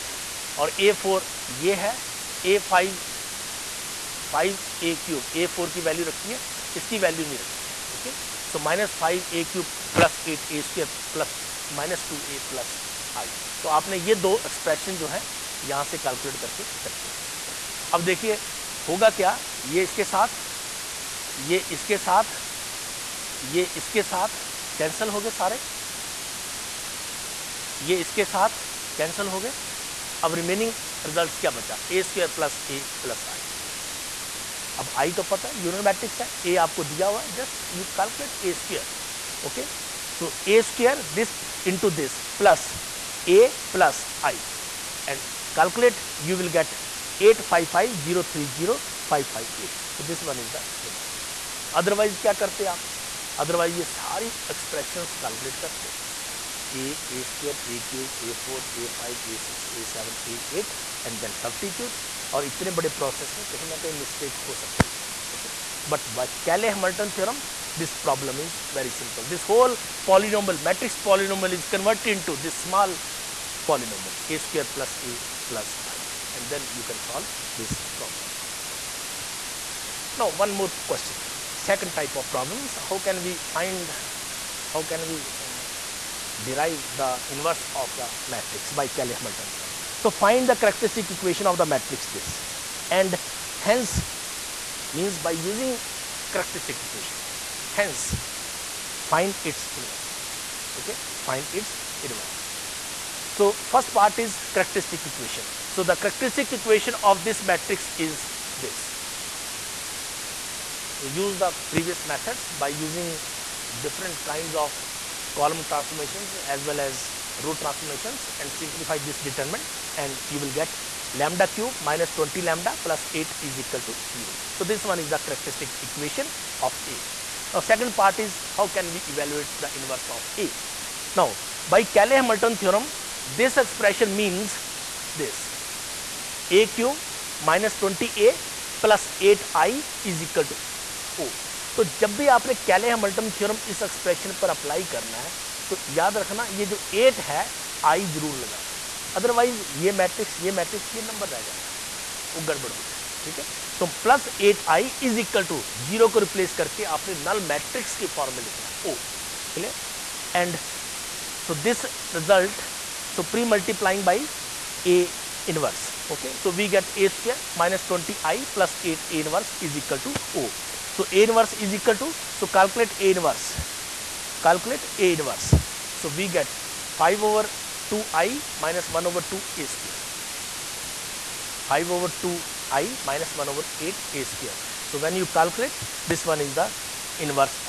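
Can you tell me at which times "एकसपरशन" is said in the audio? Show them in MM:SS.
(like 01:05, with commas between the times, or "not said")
00:14, 02:23.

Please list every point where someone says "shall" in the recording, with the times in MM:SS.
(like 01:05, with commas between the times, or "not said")
not said.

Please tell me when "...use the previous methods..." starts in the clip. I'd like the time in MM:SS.
01:51.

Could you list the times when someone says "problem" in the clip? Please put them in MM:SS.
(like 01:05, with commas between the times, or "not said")
01:07, 01:17, 01:22.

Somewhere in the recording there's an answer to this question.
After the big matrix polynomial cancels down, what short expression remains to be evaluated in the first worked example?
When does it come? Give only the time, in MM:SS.
00:31.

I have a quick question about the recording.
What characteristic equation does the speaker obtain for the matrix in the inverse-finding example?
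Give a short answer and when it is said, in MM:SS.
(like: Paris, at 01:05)
λ³ − 20λ + 8 = 0, at 02:01.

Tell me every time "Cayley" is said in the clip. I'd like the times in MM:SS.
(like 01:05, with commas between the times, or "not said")
01:28, 02:11.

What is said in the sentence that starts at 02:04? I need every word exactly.
So, this one is the characteristic equation of A.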